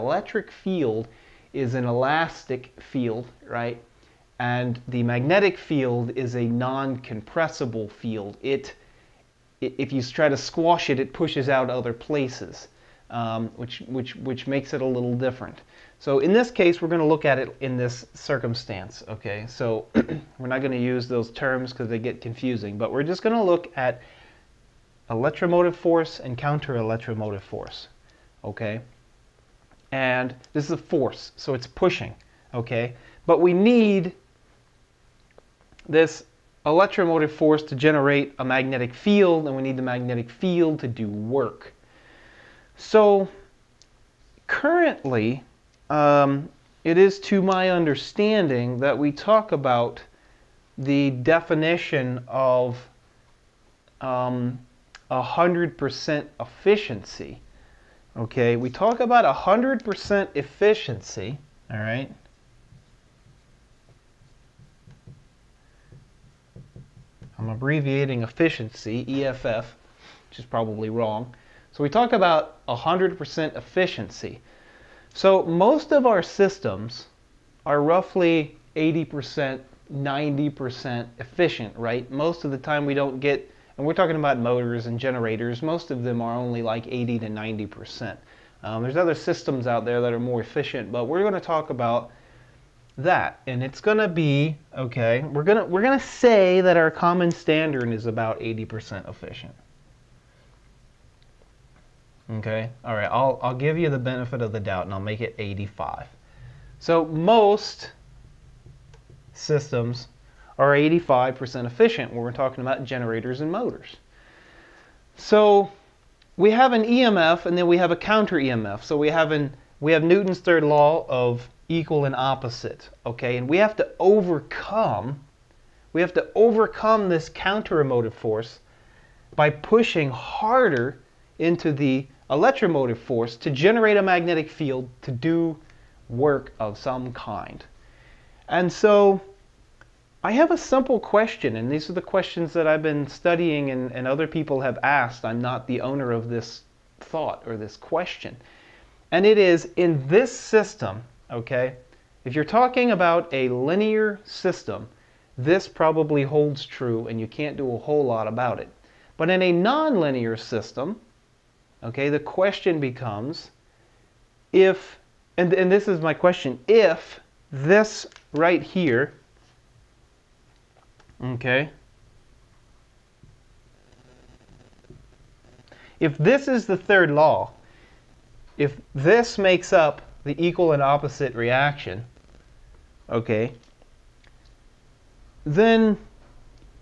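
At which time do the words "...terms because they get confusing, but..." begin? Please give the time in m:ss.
0:21.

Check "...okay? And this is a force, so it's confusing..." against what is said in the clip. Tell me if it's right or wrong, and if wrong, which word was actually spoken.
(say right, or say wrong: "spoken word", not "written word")
wrong: "pushing", not "confusing".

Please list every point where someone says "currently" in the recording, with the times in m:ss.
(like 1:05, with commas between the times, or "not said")
0:44.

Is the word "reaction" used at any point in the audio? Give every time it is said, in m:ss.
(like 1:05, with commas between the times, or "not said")
3:01.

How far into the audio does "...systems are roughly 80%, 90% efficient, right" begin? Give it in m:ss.
1:16.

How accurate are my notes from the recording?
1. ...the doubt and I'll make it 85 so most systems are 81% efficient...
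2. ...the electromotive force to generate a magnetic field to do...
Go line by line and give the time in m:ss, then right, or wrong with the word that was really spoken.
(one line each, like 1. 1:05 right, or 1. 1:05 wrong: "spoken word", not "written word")
1. 1:44 wrong: "85", not "81"
2. 2:11 right.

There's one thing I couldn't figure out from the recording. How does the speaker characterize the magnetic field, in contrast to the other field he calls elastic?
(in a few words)
non-compressible.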